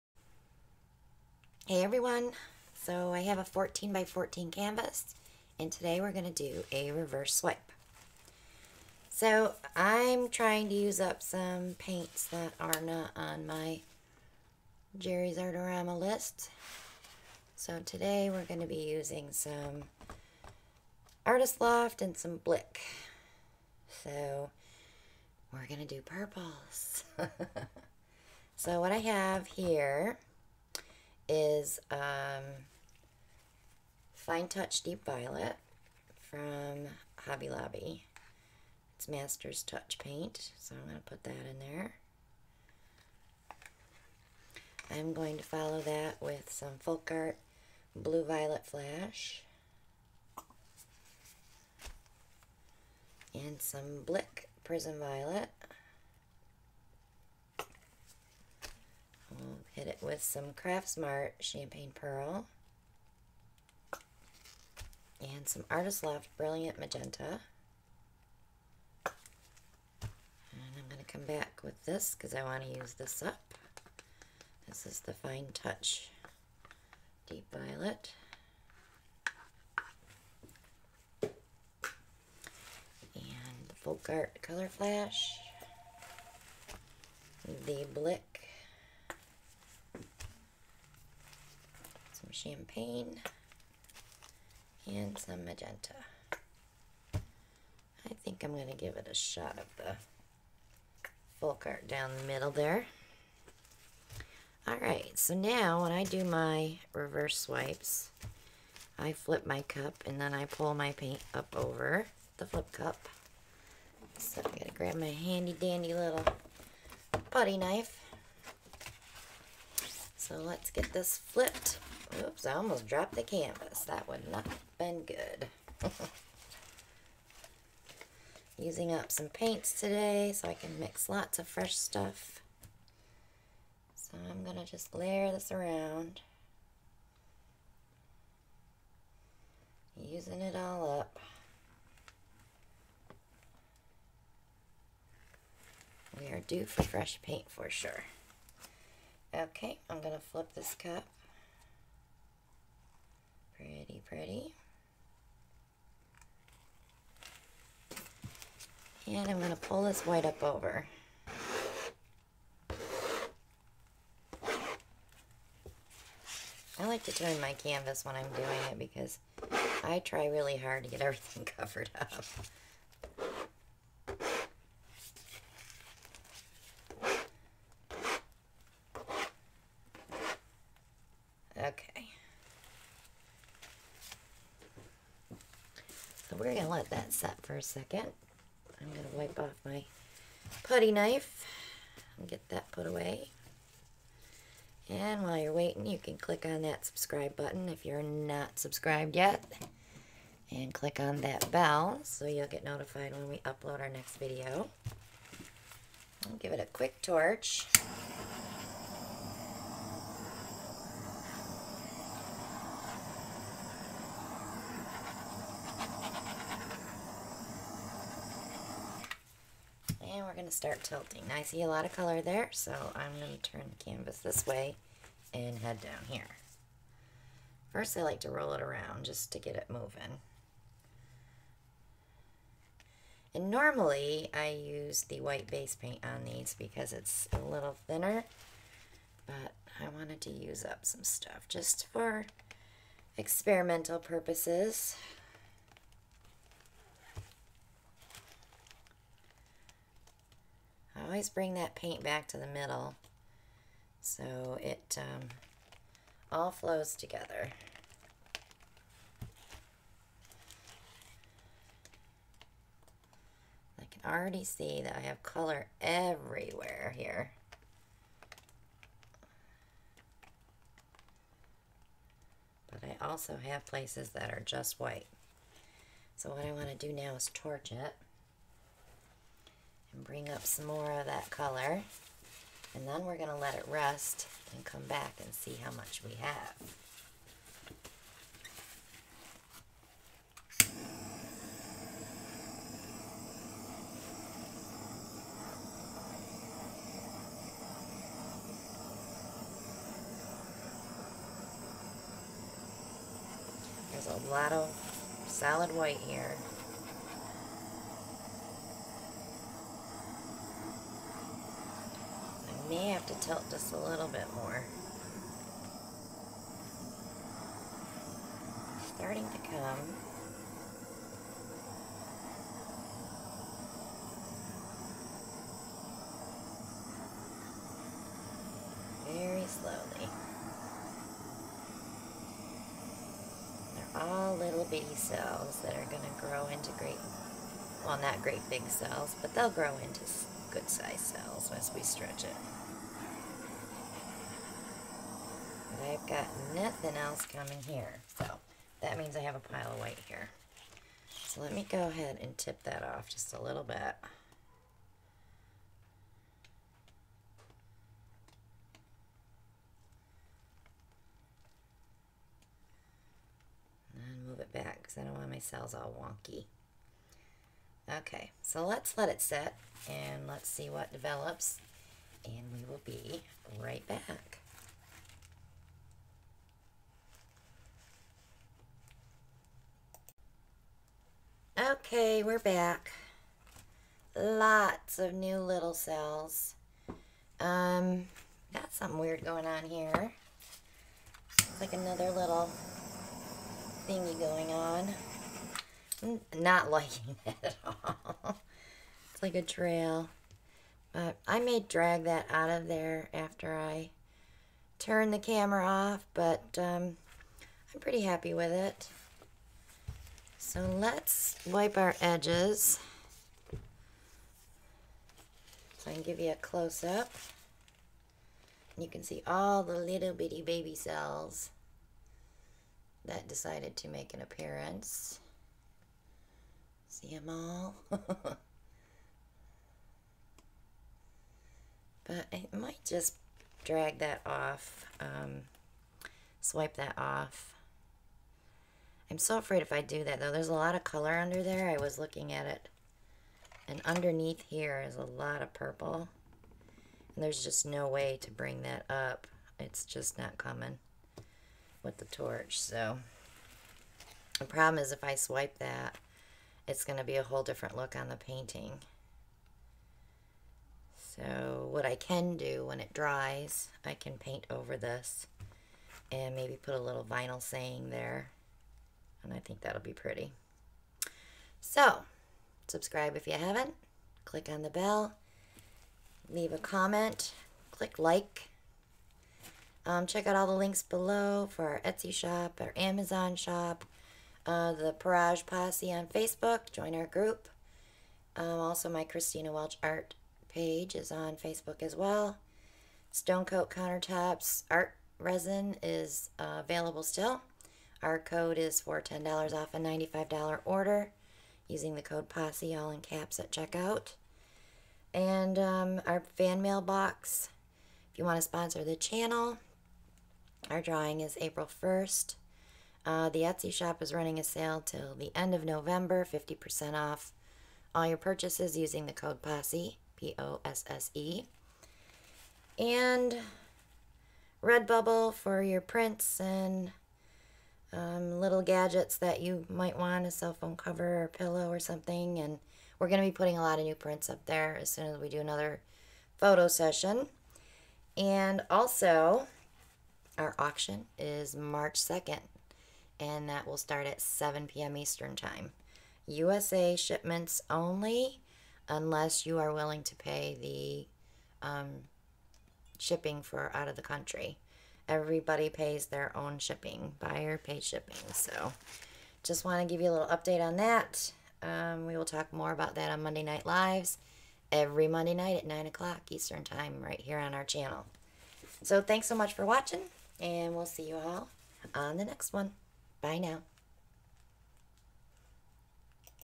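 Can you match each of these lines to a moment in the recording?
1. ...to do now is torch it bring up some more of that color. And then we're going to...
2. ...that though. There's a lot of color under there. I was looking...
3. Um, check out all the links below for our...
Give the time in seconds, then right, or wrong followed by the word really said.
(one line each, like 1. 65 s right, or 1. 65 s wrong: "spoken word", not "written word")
1. 276 s right
2. 440 s right
3. 479 s right.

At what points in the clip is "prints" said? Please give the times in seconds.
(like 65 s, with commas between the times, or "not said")
525 s, 533 s.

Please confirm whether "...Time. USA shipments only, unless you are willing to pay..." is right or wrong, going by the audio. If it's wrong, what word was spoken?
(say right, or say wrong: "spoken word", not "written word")
right.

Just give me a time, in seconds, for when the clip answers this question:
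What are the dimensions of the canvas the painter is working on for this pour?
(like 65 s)
3 s.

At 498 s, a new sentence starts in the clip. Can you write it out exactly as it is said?
Our code is for $10 off a $95 order using the code POSSE, all in caps, at checkout.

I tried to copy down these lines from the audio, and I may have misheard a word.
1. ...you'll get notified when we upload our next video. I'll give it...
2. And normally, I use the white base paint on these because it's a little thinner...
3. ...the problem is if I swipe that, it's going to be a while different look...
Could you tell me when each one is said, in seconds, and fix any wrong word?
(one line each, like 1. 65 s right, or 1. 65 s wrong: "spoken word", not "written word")
1. 202 s right
2. 233 s right
3. 454 s wrong: "whole", not "while".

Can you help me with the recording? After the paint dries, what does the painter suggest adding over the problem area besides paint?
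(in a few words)
vinyl saying.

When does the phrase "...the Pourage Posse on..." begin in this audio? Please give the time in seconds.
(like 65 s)
484 s.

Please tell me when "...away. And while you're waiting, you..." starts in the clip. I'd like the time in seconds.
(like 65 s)
192 s.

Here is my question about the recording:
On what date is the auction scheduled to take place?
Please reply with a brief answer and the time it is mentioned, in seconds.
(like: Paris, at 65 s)
March 2nd, at 541 s.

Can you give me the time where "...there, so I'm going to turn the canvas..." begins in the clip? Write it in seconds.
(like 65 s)
222 s.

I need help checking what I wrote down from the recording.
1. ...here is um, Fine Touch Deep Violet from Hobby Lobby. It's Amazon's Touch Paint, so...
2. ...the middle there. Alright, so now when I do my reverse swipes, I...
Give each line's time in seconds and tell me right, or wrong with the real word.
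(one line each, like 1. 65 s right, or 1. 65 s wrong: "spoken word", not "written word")
1. 29 s wrong: "Master", not "Amazon"
2. 102 s right.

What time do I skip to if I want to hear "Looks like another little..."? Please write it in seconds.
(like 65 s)
391 s.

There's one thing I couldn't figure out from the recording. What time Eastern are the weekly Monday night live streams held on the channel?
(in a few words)
9 o'clock.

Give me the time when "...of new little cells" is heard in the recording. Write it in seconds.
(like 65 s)
384 s.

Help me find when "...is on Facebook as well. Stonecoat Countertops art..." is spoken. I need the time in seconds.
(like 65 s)
490 s.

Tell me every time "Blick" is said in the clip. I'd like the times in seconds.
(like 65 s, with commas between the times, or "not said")
22 s, 54 s, 87 s.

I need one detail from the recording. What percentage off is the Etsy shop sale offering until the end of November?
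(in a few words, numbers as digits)
50%.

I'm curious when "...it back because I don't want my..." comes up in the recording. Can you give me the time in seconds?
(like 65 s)
364 s.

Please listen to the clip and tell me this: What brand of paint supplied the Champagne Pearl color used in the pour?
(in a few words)
Craft Smart.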